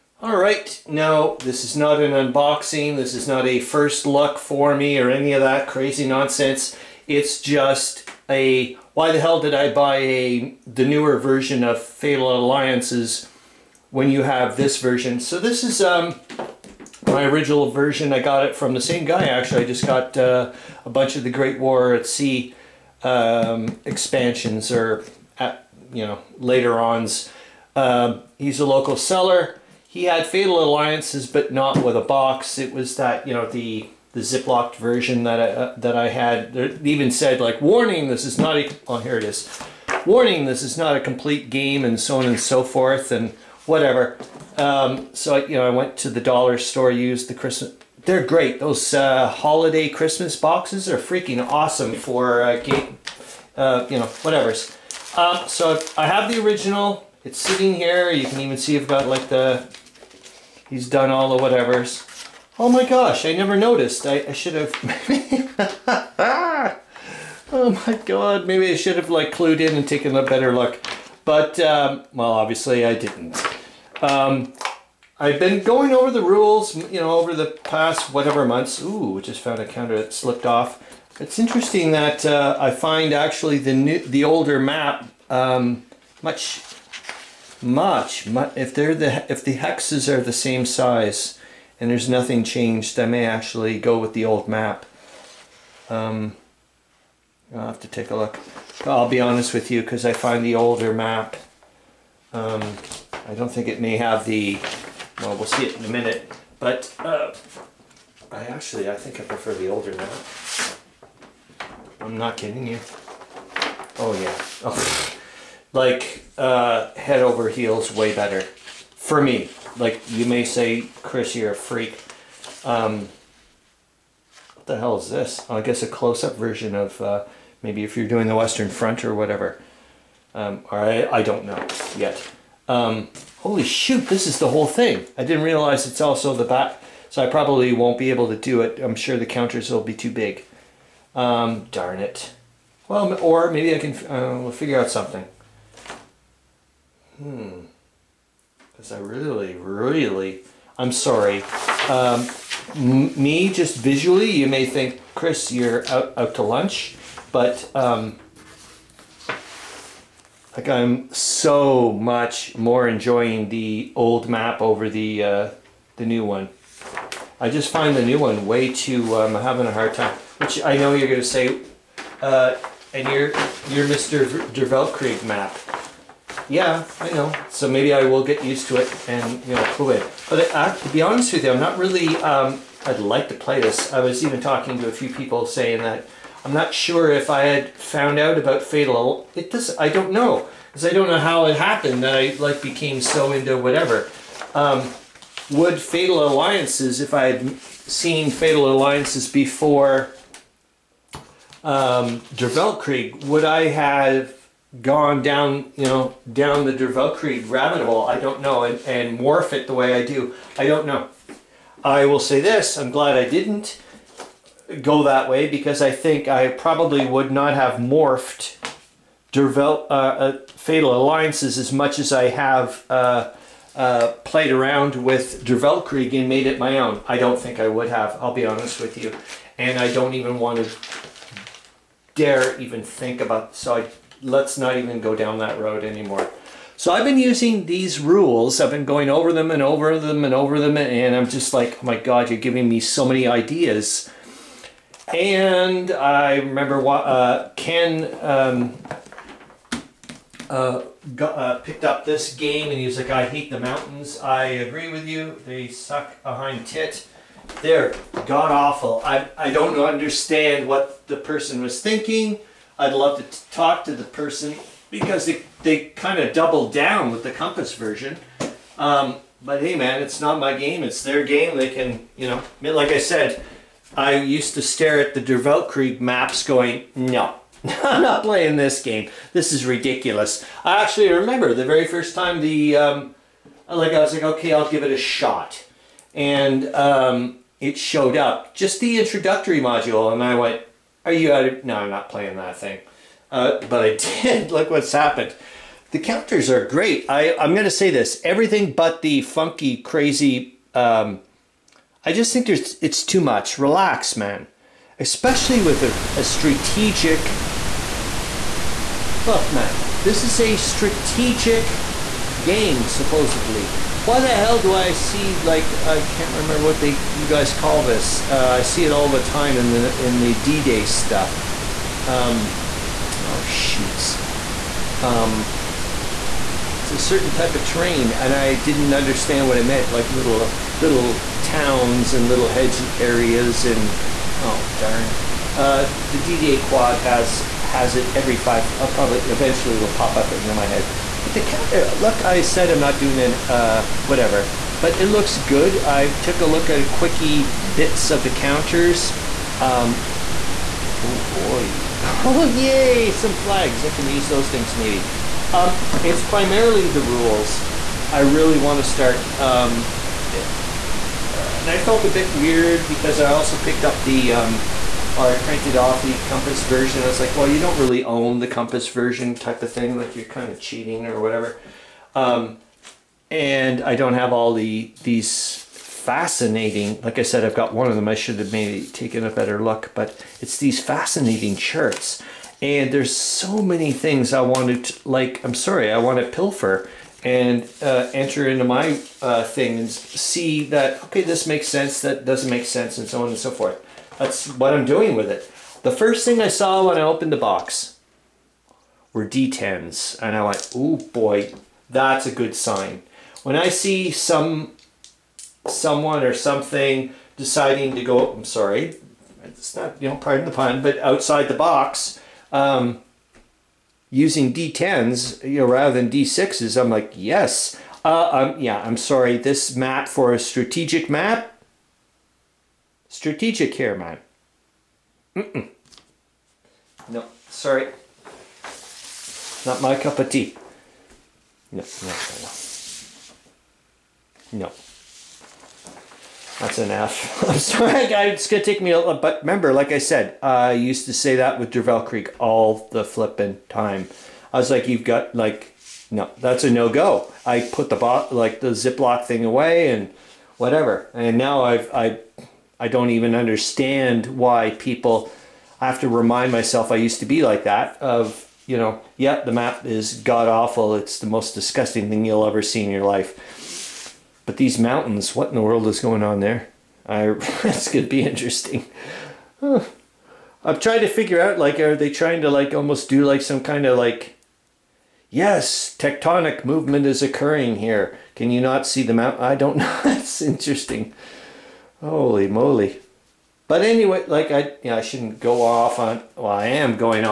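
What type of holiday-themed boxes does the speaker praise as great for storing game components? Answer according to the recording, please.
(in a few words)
Christmas boxes.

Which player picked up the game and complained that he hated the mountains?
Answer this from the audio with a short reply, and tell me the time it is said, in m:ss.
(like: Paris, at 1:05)
Ken, at 4:07.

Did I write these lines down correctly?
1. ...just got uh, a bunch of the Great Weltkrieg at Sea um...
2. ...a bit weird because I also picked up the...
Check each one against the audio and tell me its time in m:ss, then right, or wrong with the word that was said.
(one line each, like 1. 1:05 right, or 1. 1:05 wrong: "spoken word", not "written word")
1. 0:19 wrong: "War", not "Weltkrieg"
2. 6:02 right.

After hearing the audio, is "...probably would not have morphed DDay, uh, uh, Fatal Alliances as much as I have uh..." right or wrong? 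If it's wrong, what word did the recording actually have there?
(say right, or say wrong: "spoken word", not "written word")
wrong: "Dervel", not "DDay".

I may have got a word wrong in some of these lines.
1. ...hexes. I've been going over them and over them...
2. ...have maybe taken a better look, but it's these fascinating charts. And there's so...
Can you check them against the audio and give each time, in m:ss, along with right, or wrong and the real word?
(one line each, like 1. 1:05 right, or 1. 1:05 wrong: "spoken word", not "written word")
1. 3:57 wrong: "rules", not "hexes"
2. 6:18 right.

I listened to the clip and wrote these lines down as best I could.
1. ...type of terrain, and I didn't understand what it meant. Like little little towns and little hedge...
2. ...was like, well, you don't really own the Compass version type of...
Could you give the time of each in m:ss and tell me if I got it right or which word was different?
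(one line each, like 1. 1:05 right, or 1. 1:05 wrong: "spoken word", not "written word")
1. 5:27 right
2. 6:07 right.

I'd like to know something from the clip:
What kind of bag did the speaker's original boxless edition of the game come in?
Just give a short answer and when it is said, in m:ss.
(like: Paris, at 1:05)
ziplocked, at 0:34.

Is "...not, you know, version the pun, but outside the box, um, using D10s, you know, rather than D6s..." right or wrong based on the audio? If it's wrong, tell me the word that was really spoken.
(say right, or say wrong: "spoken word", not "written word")
wrong: "pardon", not "version".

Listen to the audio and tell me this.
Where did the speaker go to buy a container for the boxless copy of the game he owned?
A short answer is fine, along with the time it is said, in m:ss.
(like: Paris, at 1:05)
dollar store, at 0:46.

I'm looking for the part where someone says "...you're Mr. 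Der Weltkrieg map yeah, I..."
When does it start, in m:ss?
2:53.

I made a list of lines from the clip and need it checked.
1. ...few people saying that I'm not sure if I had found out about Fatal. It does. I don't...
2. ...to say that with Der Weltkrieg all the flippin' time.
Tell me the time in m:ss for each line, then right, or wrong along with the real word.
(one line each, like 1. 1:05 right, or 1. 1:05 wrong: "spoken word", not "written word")
1. 3:04 right
2. 7:21 right.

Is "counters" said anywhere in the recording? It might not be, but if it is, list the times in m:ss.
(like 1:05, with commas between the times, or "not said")
1:19, 2:19, 4:55, 5:41, 5:48.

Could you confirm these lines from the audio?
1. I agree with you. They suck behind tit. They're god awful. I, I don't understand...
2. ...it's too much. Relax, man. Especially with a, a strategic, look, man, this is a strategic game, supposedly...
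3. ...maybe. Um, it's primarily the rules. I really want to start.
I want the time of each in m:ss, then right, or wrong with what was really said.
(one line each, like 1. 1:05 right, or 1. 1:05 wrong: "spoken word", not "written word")
1. 4:14 right
2. 5:02 right
3. 5:54 right.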